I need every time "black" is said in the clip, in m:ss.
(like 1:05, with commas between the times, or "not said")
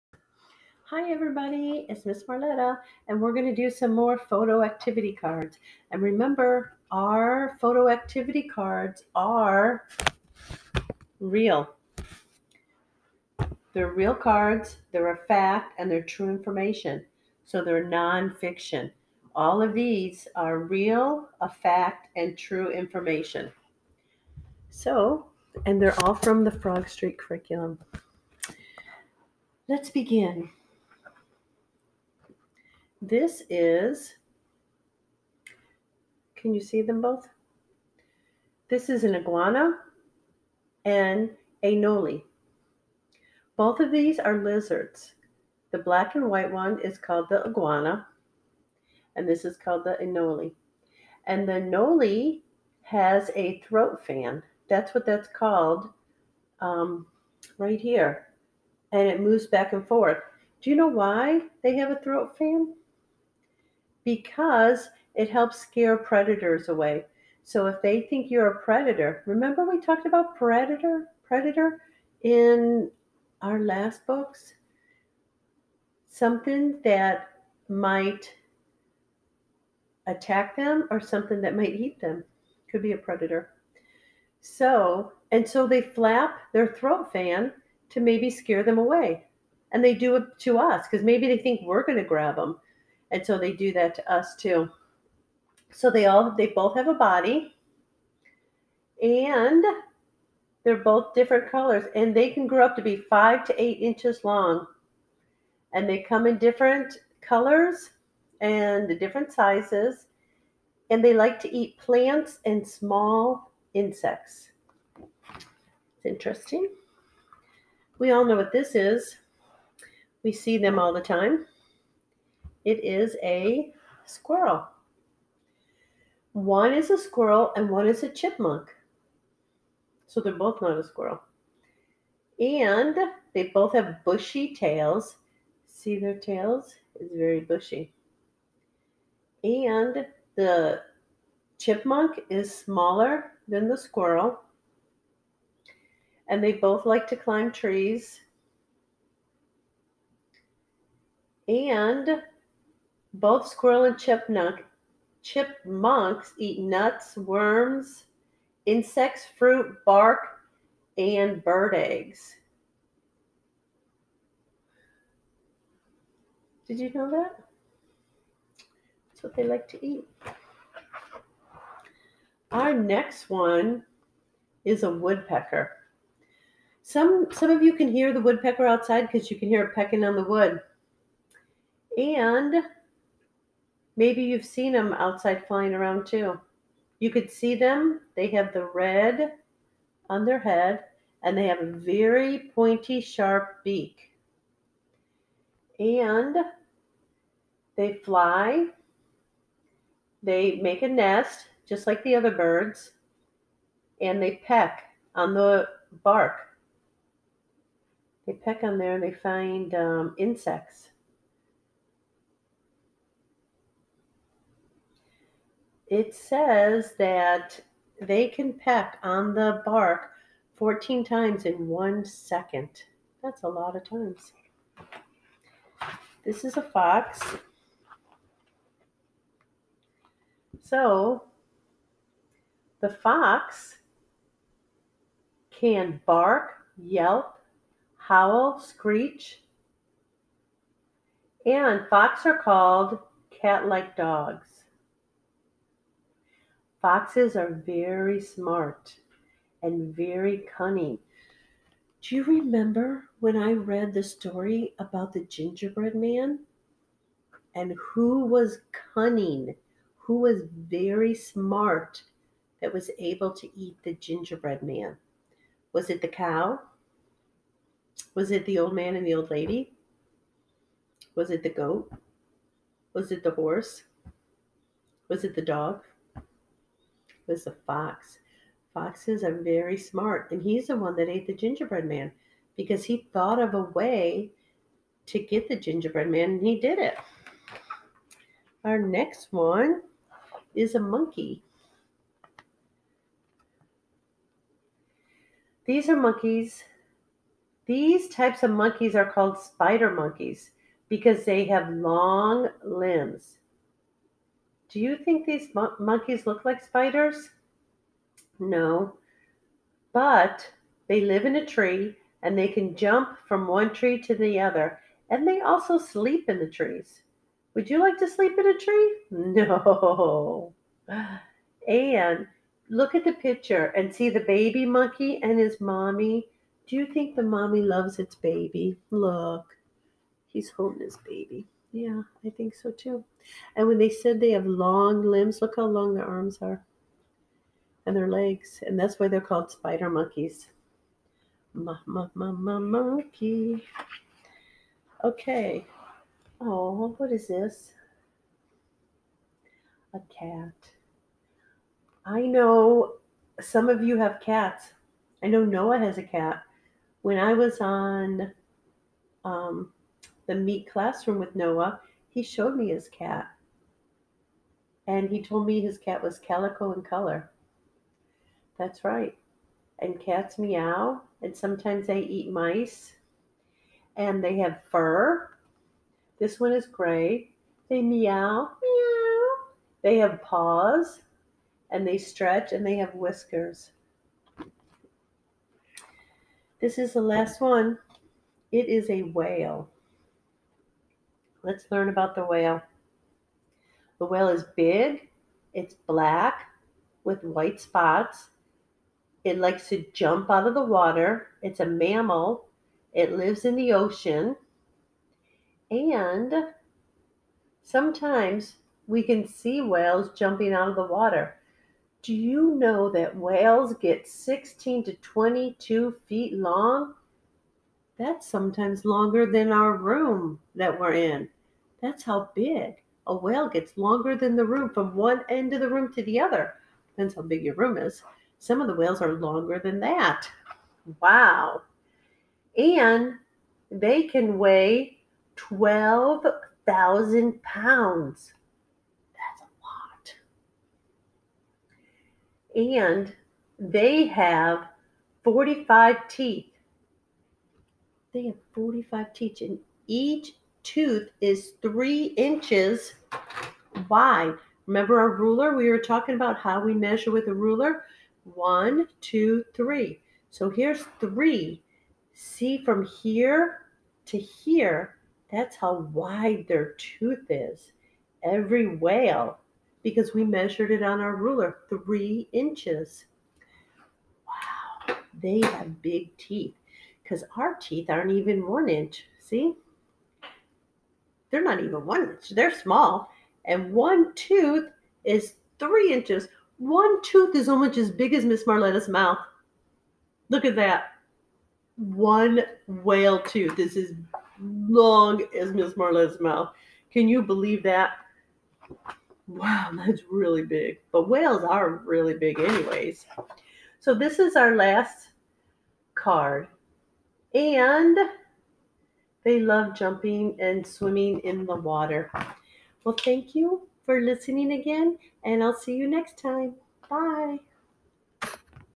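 0:45, 6:35.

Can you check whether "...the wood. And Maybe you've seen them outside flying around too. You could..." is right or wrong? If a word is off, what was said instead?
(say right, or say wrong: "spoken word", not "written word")
right.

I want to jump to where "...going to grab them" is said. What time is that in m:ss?
1:31.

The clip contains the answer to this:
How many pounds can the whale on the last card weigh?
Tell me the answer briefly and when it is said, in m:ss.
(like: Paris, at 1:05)
12,000, at 7:15.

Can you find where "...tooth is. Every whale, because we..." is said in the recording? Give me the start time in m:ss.
7:46.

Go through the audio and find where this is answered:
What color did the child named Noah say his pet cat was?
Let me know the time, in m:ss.
6:06.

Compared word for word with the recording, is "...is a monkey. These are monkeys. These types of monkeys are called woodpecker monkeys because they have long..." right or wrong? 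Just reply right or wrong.
wrong.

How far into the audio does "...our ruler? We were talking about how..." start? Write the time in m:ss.
7:34.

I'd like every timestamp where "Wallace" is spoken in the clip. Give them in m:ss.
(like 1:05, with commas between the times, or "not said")
not said.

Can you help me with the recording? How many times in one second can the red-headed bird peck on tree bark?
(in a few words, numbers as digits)
14.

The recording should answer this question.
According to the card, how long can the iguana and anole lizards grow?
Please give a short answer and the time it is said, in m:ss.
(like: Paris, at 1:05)
5 to 8 inches, at 1:42.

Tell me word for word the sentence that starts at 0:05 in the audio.
And remember, our photo activity cards are real.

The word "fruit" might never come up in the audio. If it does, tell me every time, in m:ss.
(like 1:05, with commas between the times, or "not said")
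2:39.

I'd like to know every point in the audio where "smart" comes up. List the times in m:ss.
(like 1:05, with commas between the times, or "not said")
4:08, 4:21, 4:39.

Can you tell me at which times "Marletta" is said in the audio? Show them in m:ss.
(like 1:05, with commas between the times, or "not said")
0:02, 8:08, 8:15.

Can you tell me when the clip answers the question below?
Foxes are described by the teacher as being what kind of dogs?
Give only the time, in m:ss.
4:03.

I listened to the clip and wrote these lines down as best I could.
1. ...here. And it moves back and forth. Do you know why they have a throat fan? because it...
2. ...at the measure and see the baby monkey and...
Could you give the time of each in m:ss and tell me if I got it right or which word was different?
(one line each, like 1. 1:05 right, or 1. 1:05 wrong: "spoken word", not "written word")
1. 0:57 right
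2. 5:22 wrong: "picture", not "measure".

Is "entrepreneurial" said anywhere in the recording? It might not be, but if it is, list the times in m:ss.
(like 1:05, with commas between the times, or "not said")
not said.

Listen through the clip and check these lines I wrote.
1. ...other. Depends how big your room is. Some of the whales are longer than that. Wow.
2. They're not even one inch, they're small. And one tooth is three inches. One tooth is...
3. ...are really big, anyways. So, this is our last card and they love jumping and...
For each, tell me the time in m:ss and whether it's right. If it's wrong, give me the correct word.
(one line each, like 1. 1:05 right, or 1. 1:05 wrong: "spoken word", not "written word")
1. 7:06 right
2. 8:01 right
3. 8:21 right.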